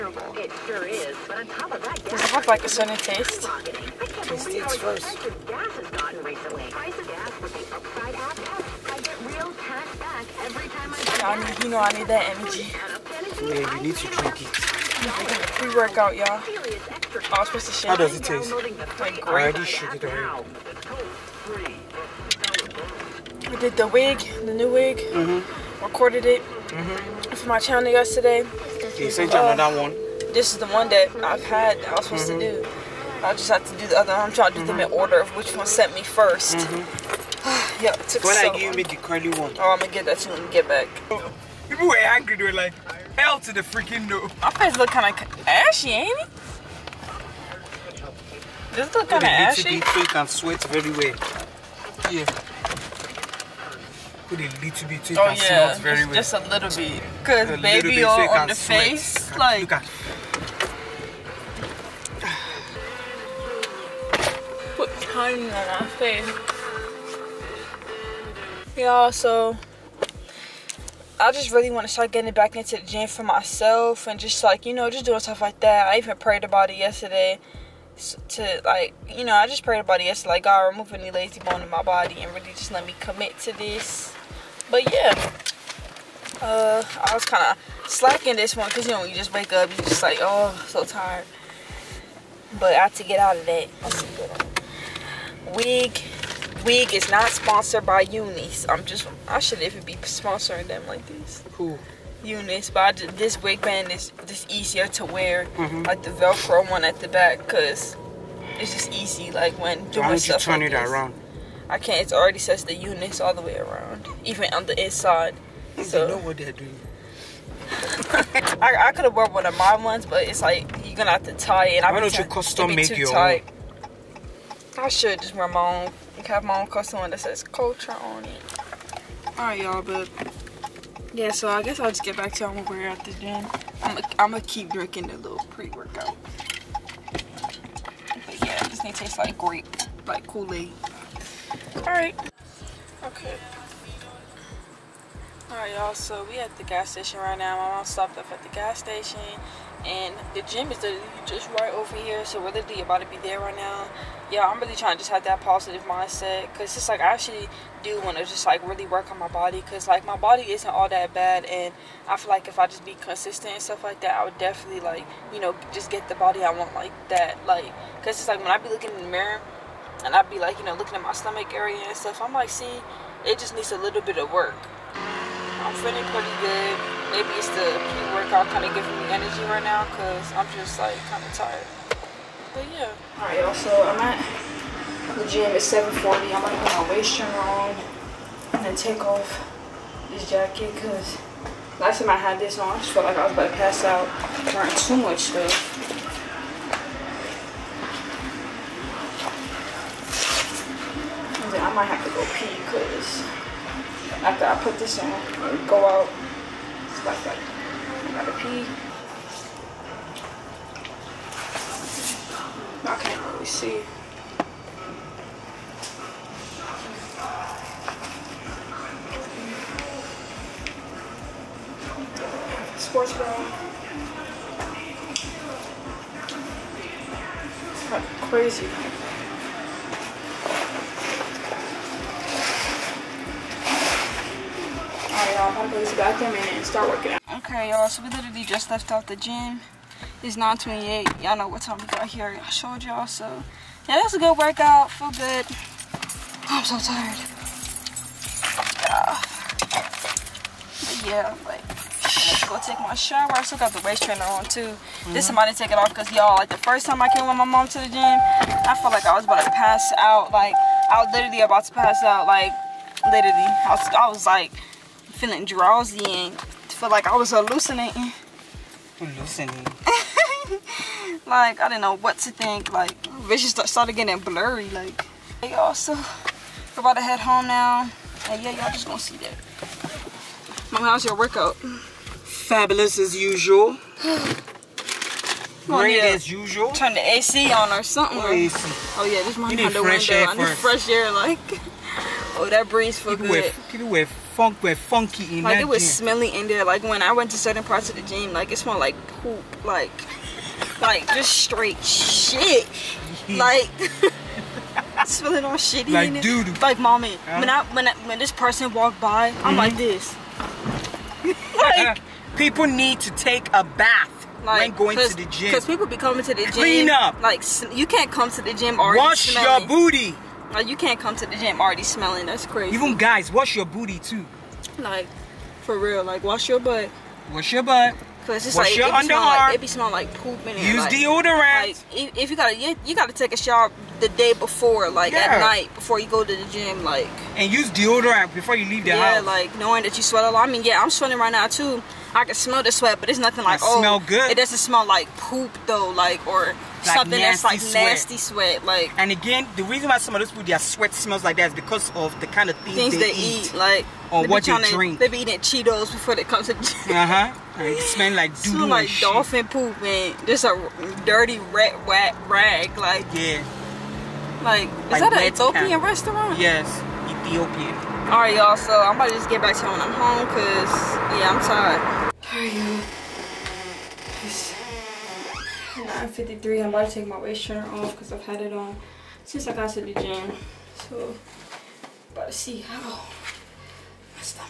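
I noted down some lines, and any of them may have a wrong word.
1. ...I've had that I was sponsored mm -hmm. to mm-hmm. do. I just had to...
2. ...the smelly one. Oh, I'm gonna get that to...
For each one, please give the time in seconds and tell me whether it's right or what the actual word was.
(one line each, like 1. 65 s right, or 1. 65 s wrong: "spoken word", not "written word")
1. 31 s wrong: "supposed", not "sponsored"
2. 38 s wrong: "curly", not "smelly".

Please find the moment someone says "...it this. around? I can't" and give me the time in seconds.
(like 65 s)
110 s.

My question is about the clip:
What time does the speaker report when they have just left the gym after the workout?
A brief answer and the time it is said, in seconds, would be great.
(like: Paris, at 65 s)
9:28, at 240 s.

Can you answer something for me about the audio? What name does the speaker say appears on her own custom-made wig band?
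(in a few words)
Kotra.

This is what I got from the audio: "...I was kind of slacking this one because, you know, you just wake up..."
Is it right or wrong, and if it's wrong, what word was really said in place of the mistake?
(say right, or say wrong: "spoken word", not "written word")
right.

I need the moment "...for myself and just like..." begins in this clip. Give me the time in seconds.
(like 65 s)
73 s.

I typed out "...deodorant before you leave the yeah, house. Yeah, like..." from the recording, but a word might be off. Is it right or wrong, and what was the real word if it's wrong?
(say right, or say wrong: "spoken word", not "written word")
right.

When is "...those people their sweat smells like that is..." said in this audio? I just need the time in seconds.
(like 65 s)
350 s.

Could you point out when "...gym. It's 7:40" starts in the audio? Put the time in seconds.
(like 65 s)
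185 s.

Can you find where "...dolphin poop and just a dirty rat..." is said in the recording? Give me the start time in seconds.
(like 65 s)
358 s.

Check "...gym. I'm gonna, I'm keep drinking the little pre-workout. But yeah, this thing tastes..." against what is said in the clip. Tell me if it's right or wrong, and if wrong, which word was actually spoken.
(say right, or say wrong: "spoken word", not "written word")
right.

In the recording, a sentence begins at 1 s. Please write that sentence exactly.
But on top of that, Does it look like a certain taste?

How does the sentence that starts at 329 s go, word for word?
Like, it be smelling like poop in it.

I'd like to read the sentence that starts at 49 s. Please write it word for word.
Little bit and sweat very well.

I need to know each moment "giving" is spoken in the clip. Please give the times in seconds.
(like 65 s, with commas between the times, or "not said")
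178 s.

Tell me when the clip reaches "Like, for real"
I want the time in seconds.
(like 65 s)
324 s.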